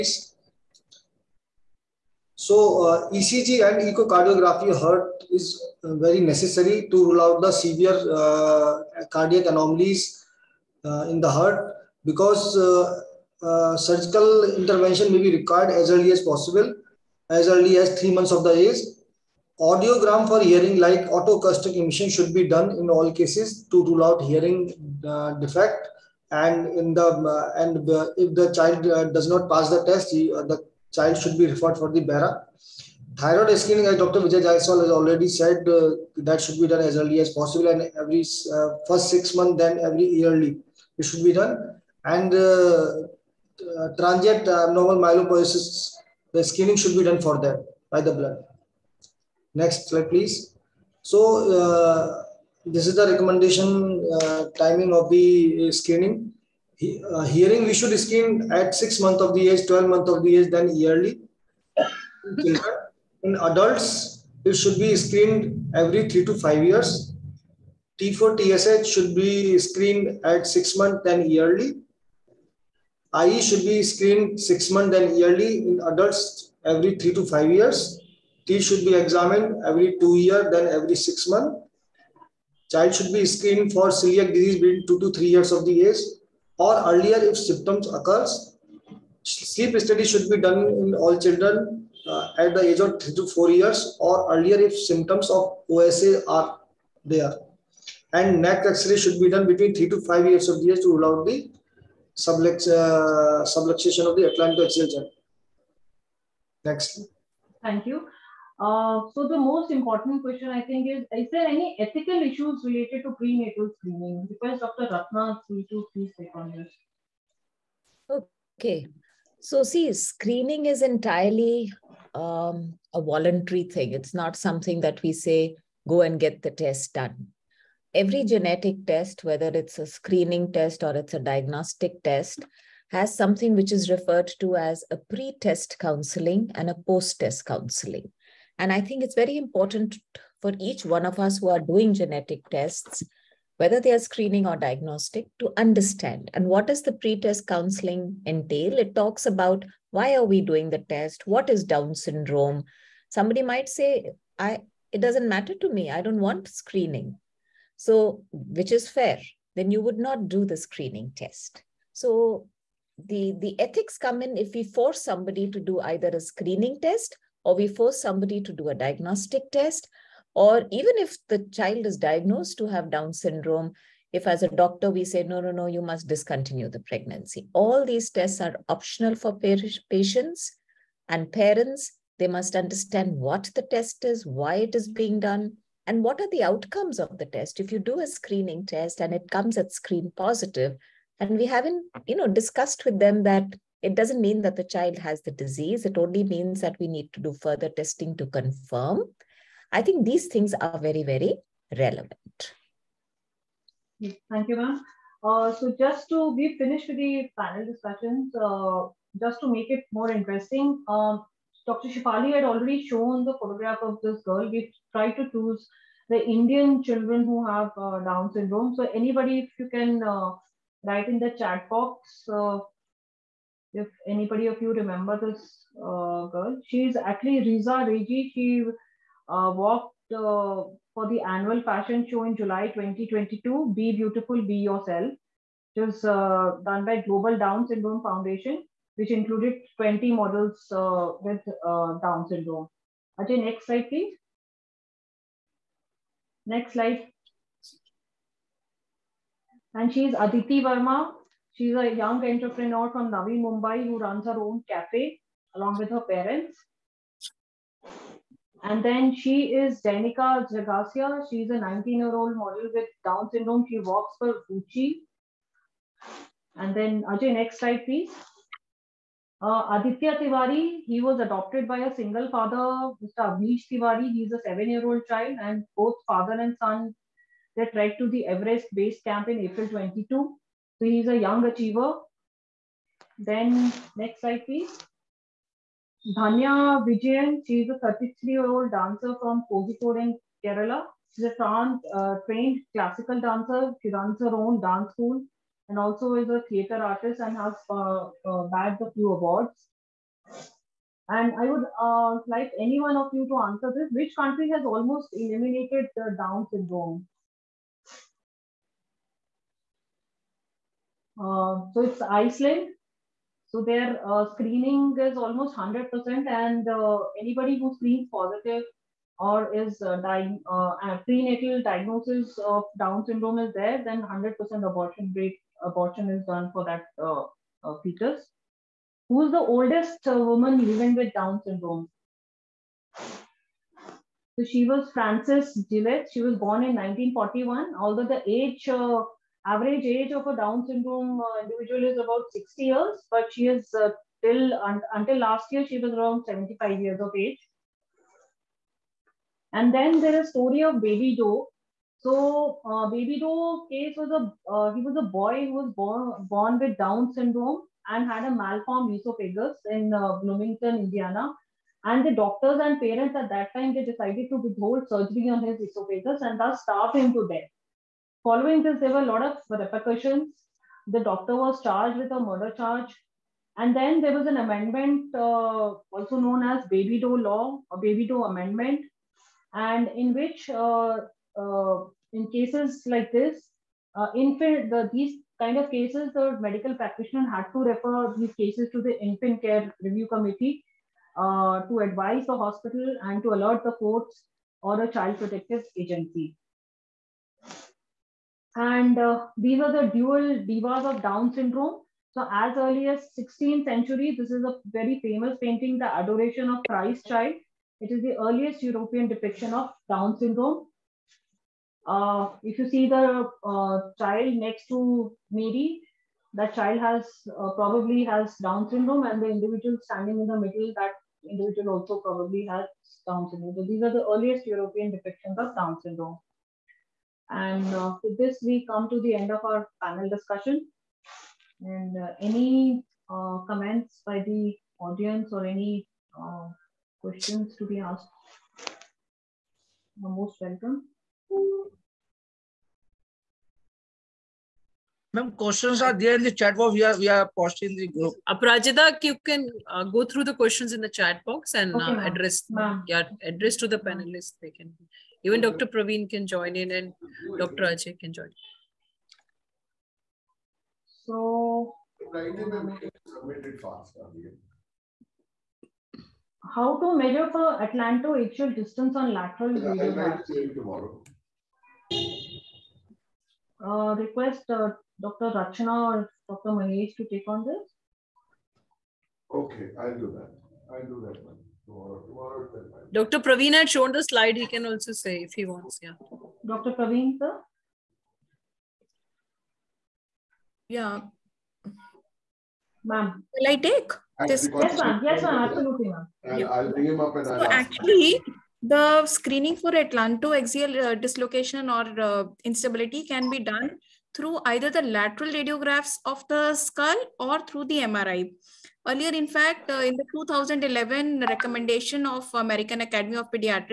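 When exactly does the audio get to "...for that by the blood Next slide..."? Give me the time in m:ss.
0:47.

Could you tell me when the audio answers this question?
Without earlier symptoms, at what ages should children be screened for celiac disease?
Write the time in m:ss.
1:24.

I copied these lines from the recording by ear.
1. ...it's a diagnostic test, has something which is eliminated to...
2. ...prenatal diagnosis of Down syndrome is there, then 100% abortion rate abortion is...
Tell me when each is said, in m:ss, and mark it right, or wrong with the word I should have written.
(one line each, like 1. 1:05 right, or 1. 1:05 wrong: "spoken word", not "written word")
1. 2:10 wrong: "referred", not "eliminated"
2. 5:21 right.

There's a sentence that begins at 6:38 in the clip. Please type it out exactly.
And uh, these are the dual divas of Down syndrome.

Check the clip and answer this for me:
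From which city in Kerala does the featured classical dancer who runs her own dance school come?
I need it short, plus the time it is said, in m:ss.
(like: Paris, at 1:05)
Kozhikode, at 4:49.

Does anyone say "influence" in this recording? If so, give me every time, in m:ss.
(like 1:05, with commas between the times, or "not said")
not said.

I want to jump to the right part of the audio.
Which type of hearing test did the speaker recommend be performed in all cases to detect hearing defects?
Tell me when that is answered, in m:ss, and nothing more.
0:21.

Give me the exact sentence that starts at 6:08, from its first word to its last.
Following this, there were a lot of repercussions.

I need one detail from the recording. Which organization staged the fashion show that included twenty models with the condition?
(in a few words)
Global Down Syndrome Foundation.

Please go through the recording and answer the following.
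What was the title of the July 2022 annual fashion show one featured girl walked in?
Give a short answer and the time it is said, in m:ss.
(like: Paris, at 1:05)
Be Beautiful, Be Yourself, at 3:53.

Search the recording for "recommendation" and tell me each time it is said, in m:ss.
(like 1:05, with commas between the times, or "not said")
0:53, 8:31.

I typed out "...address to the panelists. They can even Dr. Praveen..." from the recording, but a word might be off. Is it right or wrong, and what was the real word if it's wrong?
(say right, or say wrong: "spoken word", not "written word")
right.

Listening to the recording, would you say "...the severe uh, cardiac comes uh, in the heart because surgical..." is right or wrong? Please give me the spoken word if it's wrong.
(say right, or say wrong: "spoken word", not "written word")
wrong: "anomalies", not "comes".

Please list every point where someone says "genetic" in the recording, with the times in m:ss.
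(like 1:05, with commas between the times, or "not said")
2:08, 2:21.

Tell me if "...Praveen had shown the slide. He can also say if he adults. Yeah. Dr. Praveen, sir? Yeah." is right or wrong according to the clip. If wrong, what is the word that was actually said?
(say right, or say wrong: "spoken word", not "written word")
wrong: "wants", not "adults".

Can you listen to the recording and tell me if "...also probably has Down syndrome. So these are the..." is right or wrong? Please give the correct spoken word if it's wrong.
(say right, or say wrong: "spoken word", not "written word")
right.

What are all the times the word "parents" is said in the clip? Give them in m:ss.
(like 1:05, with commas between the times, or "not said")
3:01, 4:16, 6:02.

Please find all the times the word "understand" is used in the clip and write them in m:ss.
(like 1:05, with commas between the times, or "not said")
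2:25, 3:02.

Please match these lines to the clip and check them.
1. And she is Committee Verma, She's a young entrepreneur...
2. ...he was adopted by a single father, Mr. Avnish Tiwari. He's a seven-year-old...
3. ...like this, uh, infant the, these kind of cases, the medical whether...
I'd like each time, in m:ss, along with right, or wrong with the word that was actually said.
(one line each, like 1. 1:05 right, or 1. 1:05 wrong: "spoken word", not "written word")
1. 4:09 wrong: "Aditi", not "Committee"
2. 4:30 right
3. 6:22 wrong: "practitioner", not "whether".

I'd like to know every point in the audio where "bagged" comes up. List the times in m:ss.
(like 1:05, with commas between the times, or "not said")
4:58.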